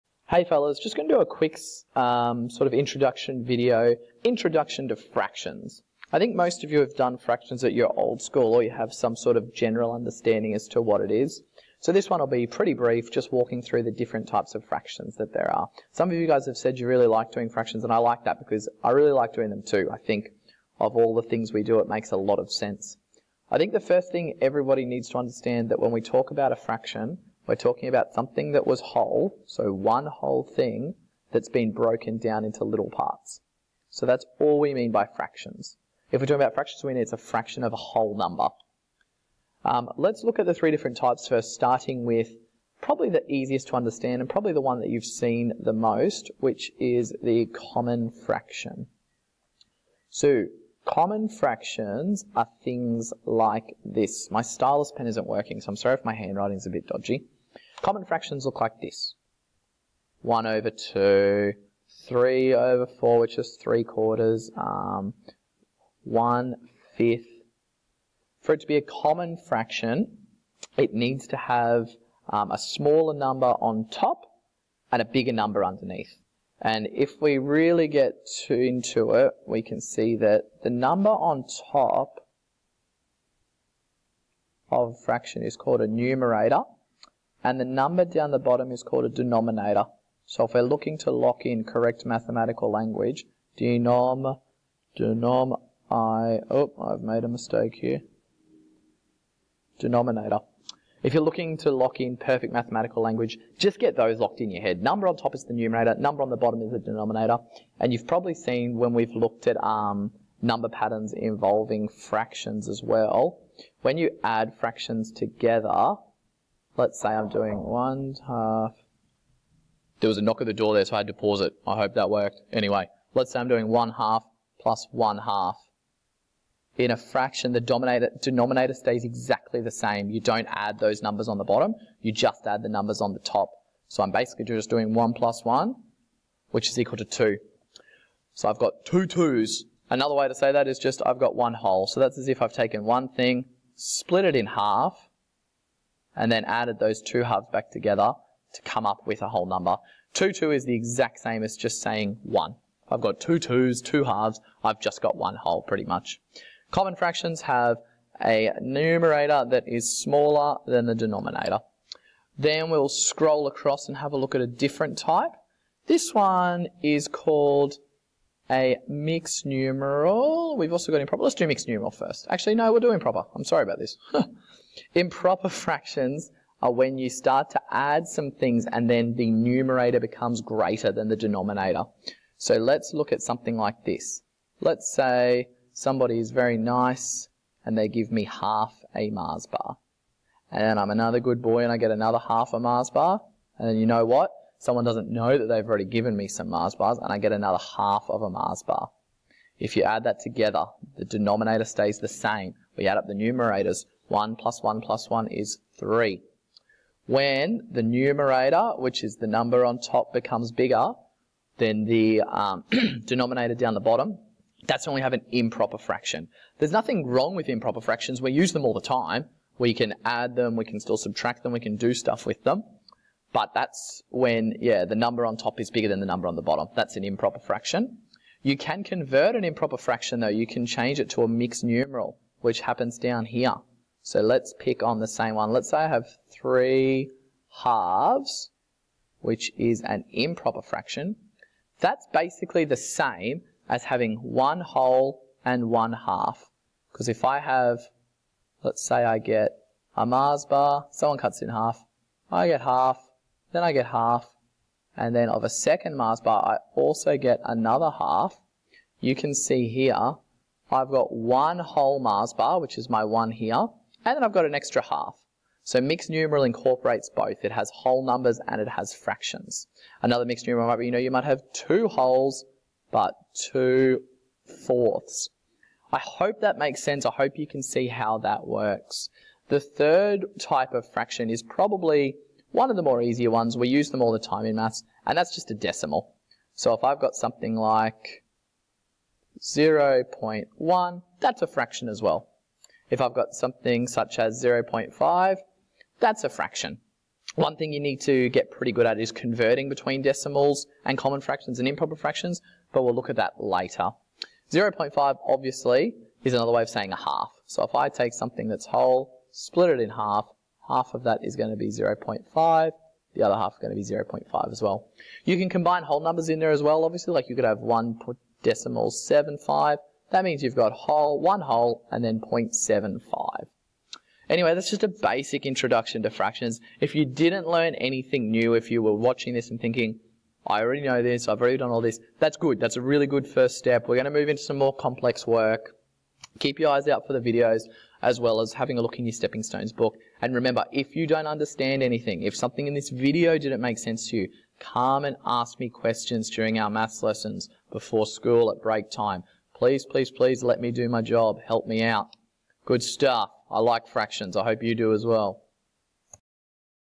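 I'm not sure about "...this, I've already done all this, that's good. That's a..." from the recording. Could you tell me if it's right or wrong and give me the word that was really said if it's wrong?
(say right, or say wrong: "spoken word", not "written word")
right.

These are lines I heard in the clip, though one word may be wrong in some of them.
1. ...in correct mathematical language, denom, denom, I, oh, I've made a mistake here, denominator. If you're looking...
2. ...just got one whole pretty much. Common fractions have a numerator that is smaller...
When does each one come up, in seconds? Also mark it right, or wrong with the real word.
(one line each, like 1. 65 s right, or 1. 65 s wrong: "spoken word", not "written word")
1. 91 s right
2. 154 s right.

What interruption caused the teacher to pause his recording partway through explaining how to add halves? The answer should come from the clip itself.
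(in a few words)
a knock at the door.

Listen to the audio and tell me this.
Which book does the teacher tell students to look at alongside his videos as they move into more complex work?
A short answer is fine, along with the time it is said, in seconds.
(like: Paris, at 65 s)
Stepping Stones, at 339 s.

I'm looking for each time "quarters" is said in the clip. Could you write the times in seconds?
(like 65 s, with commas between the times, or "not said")
63 s.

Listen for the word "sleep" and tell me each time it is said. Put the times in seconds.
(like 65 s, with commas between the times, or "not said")
not said.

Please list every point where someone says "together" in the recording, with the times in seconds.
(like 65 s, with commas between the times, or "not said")
115 s, 147 s, 200 s.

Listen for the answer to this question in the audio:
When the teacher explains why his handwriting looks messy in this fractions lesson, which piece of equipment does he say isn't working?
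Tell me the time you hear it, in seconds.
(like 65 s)
54 s.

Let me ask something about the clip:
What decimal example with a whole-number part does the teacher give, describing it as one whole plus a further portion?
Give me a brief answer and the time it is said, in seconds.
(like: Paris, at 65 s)
1.75, at 317 s.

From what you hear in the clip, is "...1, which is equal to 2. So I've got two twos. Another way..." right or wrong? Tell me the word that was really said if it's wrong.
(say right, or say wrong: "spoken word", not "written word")
right.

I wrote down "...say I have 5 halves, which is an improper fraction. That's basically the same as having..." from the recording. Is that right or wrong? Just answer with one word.
wrong.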